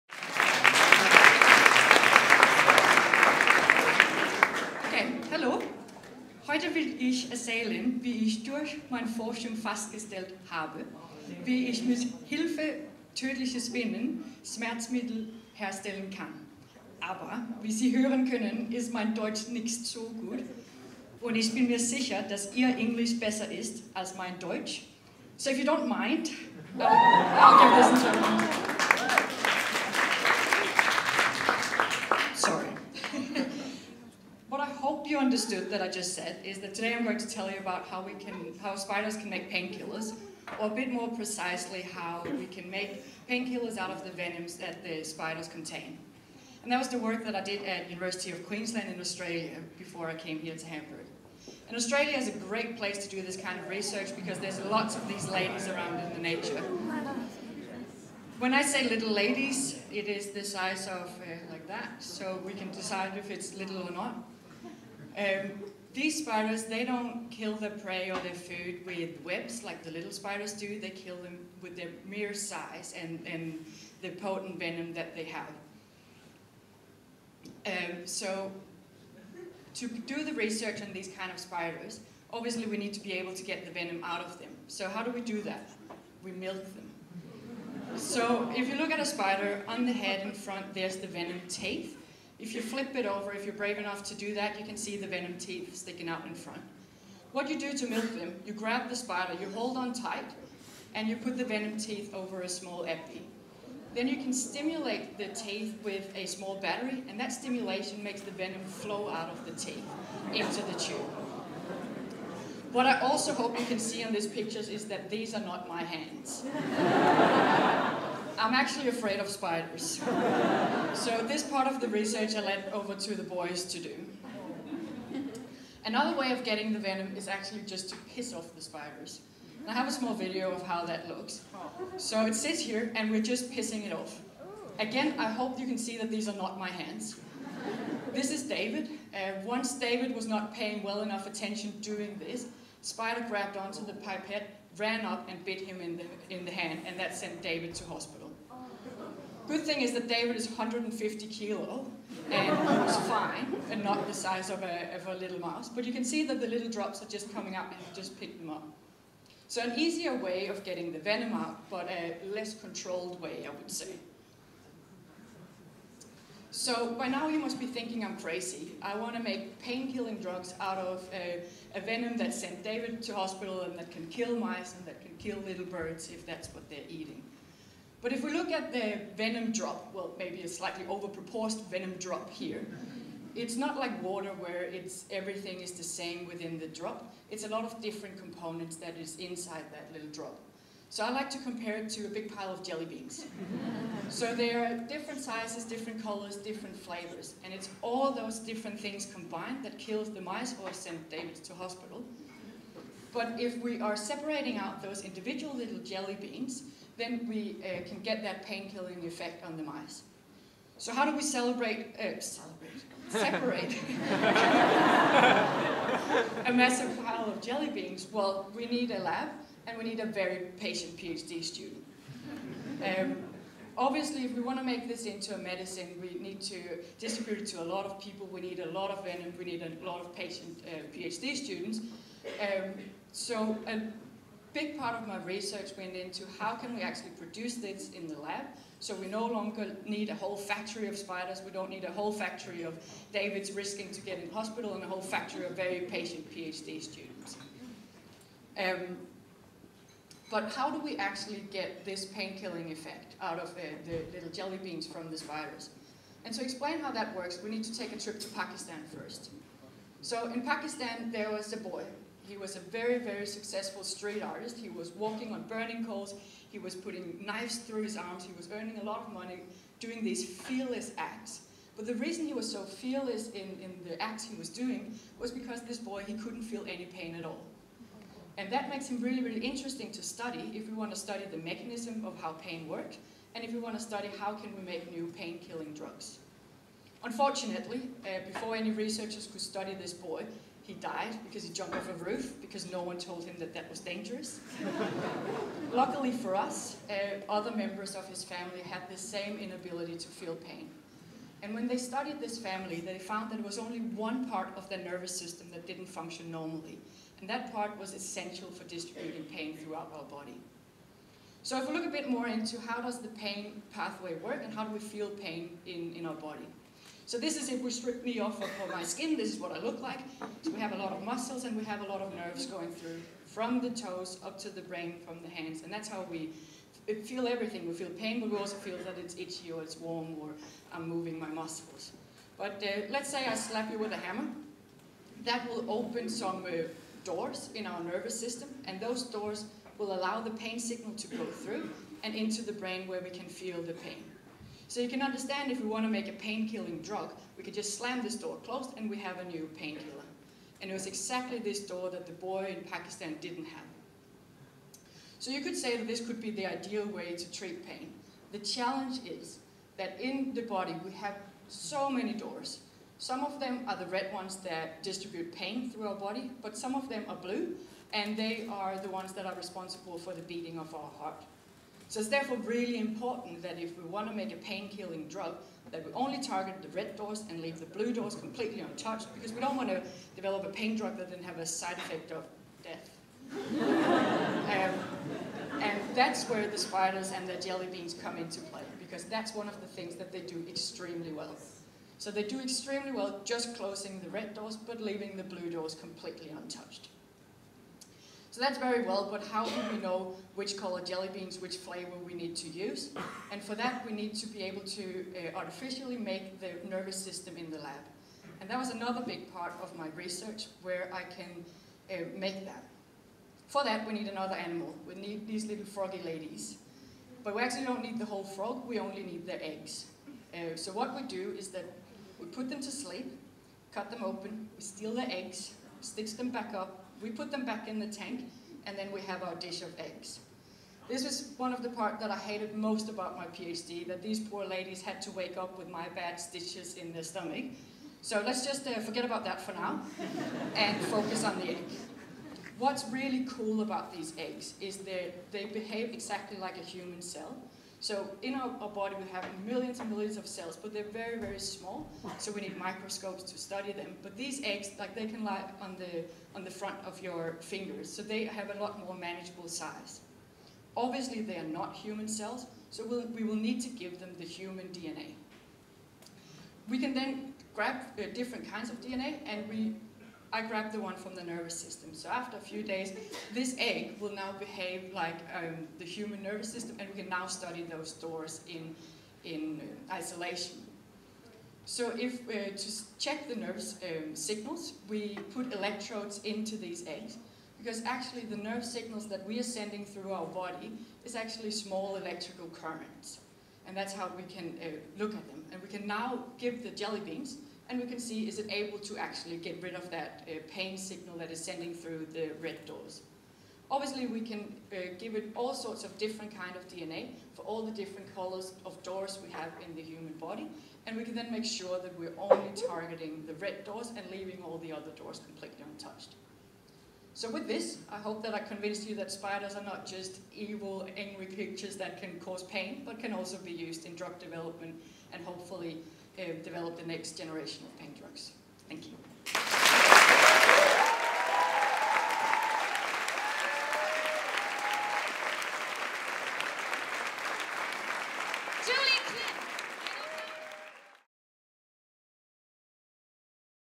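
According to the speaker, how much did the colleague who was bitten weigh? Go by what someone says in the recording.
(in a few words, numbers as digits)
150 kilos.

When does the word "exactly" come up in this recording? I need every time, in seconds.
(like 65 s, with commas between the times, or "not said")
350 s, 445 s.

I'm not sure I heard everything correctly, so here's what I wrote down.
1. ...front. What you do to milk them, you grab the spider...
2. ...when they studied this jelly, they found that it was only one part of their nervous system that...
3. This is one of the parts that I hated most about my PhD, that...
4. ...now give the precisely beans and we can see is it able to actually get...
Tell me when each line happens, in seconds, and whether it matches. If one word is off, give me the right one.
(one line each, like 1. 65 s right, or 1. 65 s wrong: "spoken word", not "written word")
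1. 96 s right
2. 301 s wrong: "family", not "jelly"
3. 430 s right
4. 495 s wrong: "jelly", not "precisely".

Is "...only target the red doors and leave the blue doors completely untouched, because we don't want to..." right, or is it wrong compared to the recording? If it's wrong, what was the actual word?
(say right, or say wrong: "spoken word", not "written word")
right.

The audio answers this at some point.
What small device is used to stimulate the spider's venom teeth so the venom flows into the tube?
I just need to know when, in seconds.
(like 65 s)
106 s.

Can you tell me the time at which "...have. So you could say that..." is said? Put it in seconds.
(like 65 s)
353 s.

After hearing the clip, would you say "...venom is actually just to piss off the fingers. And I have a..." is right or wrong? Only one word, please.
wrong.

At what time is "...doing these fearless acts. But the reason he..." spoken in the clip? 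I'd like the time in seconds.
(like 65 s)
269 s.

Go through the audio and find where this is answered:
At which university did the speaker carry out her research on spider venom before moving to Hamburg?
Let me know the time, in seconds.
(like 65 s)
47 s.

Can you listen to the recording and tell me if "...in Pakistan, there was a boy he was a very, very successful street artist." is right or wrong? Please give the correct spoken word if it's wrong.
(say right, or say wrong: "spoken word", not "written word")
right.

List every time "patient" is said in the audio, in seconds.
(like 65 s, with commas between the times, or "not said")
220 s, 230 s, 245 s.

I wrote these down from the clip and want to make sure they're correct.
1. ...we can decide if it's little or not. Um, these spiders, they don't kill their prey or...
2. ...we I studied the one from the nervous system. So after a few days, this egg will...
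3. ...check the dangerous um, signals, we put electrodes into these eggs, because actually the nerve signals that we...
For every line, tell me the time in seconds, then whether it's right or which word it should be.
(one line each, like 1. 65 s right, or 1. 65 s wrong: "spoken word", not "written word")
1. 62 s right
2. 469 s wrong: "grabbed", not "studied"
3. 482 s wrong: "nervous", not "dangerous".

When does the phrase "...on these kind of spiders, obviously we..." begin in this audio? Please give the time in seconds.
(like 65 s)
80 s.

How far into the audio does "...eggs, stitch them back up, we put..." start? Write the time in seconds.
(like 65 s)
425 s.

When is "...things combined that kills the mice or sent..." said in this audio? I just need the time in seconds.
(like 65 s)
198 s.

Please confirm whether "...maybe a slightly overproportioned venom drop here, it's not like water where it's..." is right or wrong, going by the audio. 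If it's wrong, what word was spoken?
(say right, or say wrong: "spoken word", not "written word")
right.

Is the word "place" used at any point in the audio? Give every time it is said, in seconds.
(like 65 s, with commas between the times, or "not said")
52 s.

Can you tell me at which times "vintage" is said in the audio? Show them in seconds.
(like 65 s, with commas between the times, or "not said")
not said.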